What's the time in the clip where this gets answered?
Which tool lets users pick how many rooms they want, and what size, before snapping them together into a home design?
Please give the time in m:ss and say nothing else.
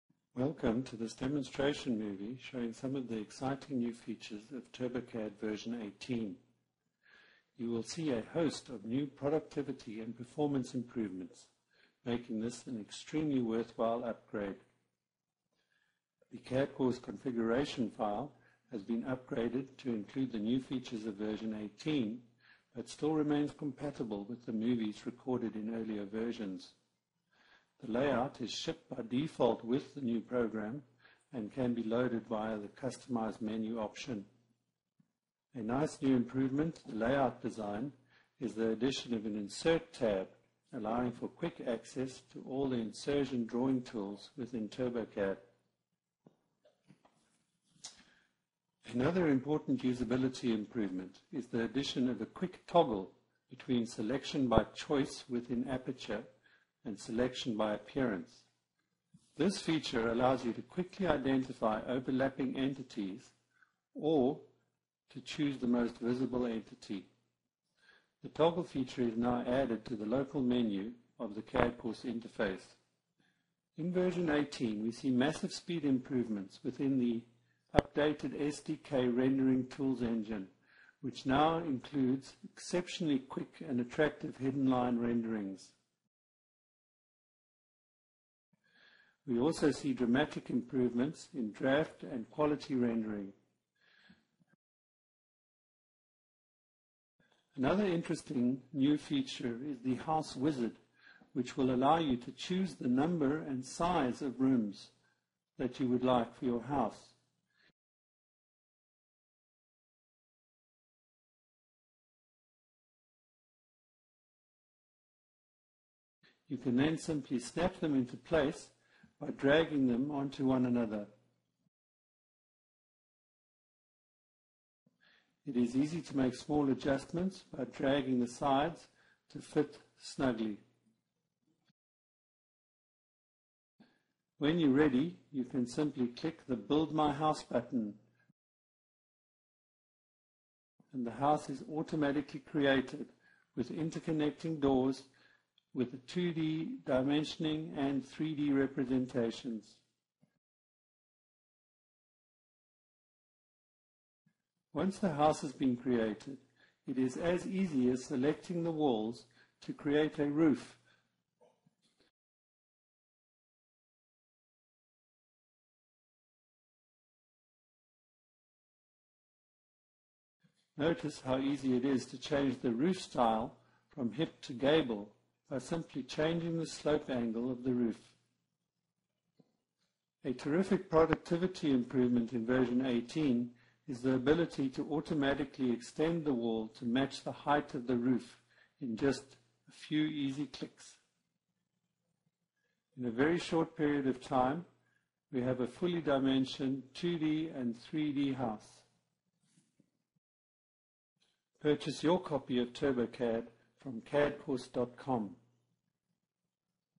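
1:39.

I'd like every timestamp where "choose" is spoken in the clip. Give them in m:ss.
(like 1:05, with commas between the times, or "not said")
1:05, 1:42.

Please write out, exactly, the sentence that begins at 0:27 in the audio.
The layout is shipped by default with the new program and can be loaded via the Customize menu option.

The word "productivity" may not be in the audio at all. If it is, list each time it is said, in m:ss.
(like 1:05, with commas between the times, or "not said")
0:09, 3:00.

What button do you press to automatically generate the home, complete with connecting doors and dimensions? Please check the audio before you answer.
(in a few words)
Build My House.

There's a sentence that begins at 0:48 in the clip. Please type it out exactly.
Another important usability improvement is the addition of a quick toggle between selection by choice within Aperture and selection by appearance.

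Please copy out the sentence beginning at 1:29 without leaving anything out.
We also see dramatic improvements in draft and quality rendering.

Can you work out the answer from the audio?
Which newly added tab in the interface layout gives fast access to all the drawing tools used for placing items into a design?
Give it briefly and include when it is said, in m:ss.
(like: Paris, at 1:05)
Insert tab, at 0:39.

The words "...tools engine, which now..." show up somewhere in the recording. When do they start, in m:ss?
1:19.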